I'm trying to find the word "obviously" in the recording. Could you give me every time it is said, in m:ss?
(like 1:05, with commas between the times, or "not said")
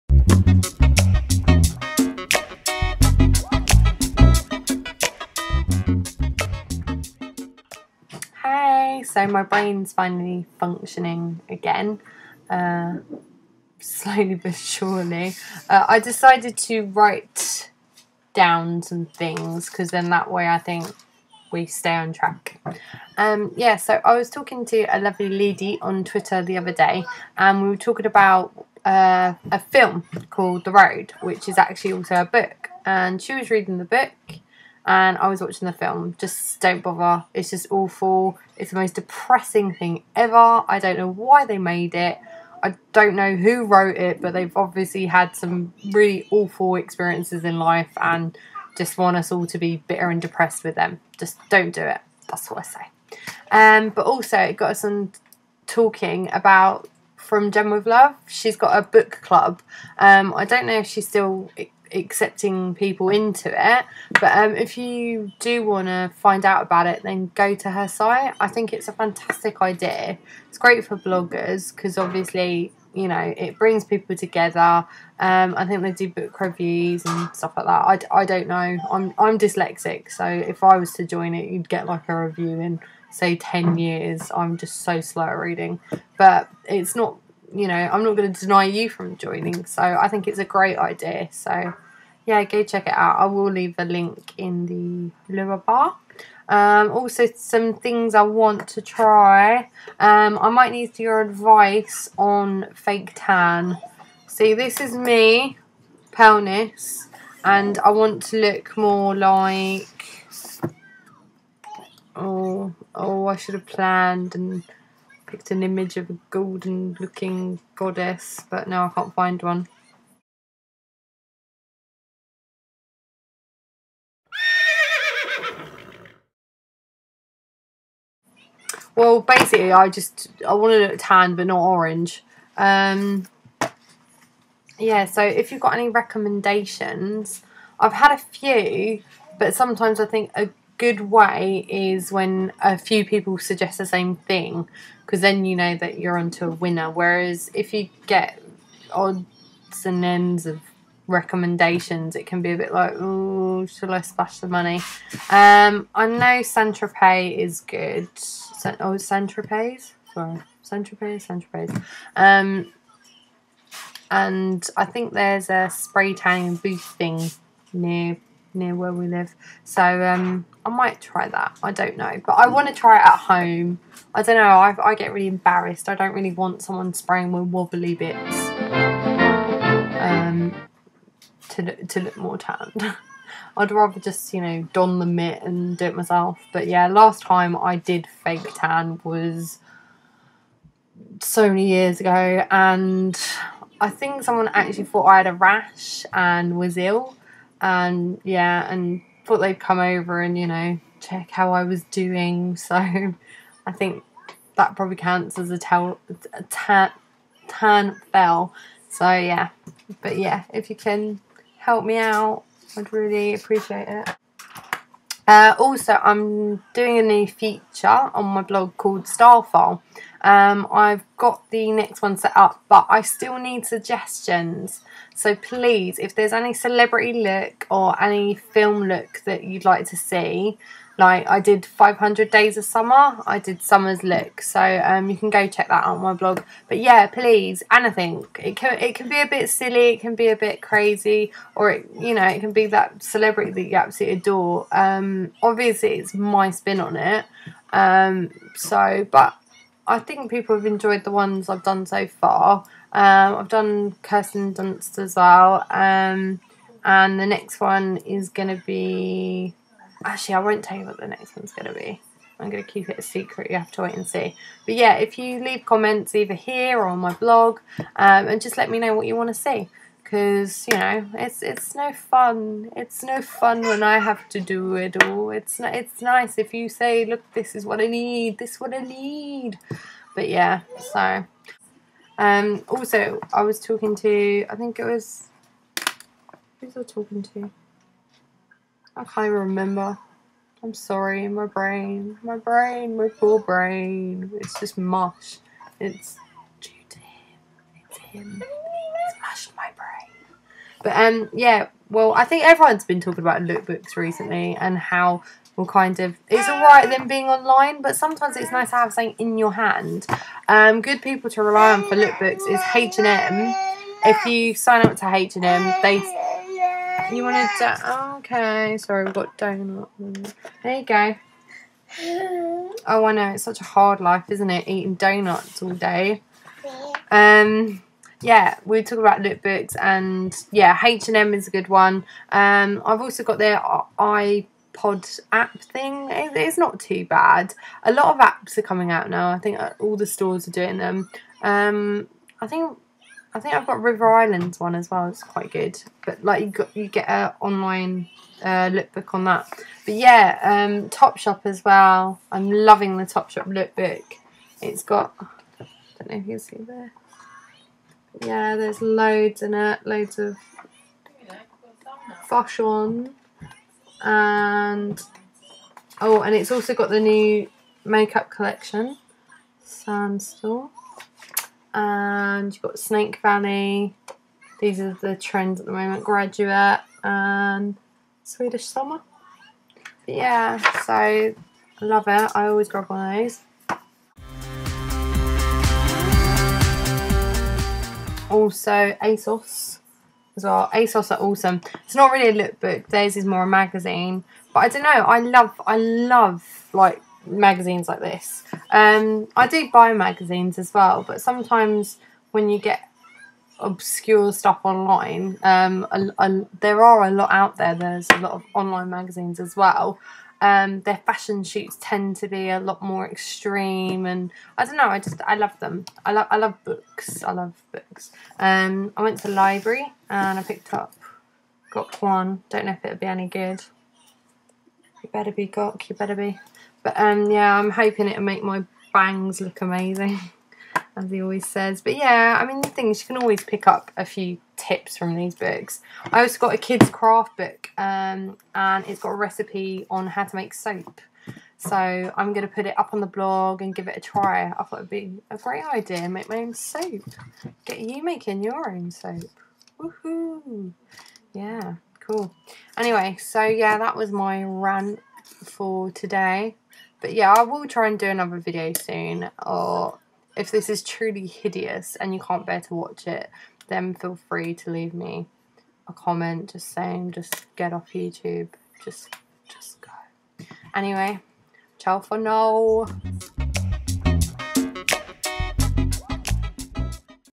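0:44, 1:11, 4:05.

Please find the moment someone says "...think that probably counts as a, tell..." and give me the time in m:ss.
3:23.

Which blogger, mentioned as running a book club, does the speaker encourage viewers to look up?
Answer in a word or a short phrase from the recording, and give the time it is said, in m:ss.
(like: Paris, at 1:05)
From Gem with Love, at 0:57.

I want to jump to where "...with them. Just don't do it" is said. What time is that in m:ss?
0:50.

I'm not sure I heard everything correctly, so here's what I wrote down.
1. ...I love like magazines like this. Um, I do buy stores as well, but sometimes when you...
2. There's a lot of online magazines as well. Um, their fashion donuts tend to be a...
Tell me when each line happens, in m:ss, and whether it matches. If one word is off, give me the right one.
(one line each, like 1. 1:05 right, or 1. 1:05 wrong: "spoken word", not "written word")
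1. 6:35 wrong: "magazines", not "stores"
2. 6:47 wrong: "shoots", not "donuts".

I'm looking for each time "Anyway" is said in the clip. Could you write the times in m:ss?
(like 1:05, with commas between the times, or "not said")
7:32, 7:50.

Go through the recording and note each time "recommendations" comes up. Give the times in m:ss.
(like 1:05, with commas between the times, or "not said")
2:15, 2:31.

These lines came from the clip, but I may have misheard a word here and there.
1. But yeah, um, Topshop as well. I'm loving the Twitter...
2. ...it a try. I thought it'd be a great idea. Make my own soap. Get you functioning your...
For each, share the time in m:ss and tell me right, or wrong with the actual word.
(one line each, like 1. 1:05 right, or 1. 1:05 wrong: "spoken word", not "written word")
1. 5:49 wrong: "Topshop", not "Twitter"
2. 7:23 wrong: "making", not "functioning".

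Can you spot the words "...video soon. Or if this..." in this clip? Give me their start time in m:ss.
7:38.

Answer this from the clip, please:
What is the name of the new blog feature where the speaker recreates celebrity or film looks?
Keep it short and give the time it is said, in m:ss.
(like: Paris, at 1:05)
Starfile, at 3:39.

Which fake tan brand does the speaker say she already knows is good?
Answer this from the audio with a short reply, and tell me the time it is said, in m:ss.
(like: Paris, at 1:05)
Saint Tropez, at 2:40.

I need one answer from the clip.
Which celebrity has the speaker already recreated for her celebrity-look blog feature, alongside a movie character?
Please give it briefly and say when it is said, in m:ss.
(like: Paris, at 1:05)
Kirsten Dunst, at 4:14.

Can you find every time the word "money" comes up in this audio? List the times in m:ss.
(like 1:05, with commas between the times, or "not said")
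2:34.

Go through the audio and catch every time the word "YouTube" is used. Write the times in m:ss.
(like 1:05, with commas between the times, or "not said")
7:47.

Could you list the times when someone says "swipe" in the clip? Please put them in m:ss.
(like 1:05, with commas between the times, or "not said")
not said.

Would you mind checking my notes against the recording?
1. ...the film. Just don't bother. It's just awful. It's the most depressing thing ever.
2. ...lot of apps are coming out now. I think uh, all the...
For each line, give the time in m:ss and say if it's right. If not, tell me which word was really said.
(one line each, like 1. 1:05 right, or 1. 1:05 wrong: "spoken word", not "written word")
1. 0:35 right
2. 5:37 right.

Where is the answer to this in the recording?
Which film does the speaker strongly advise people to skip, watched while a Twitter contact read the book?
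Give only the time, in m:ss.
0:30.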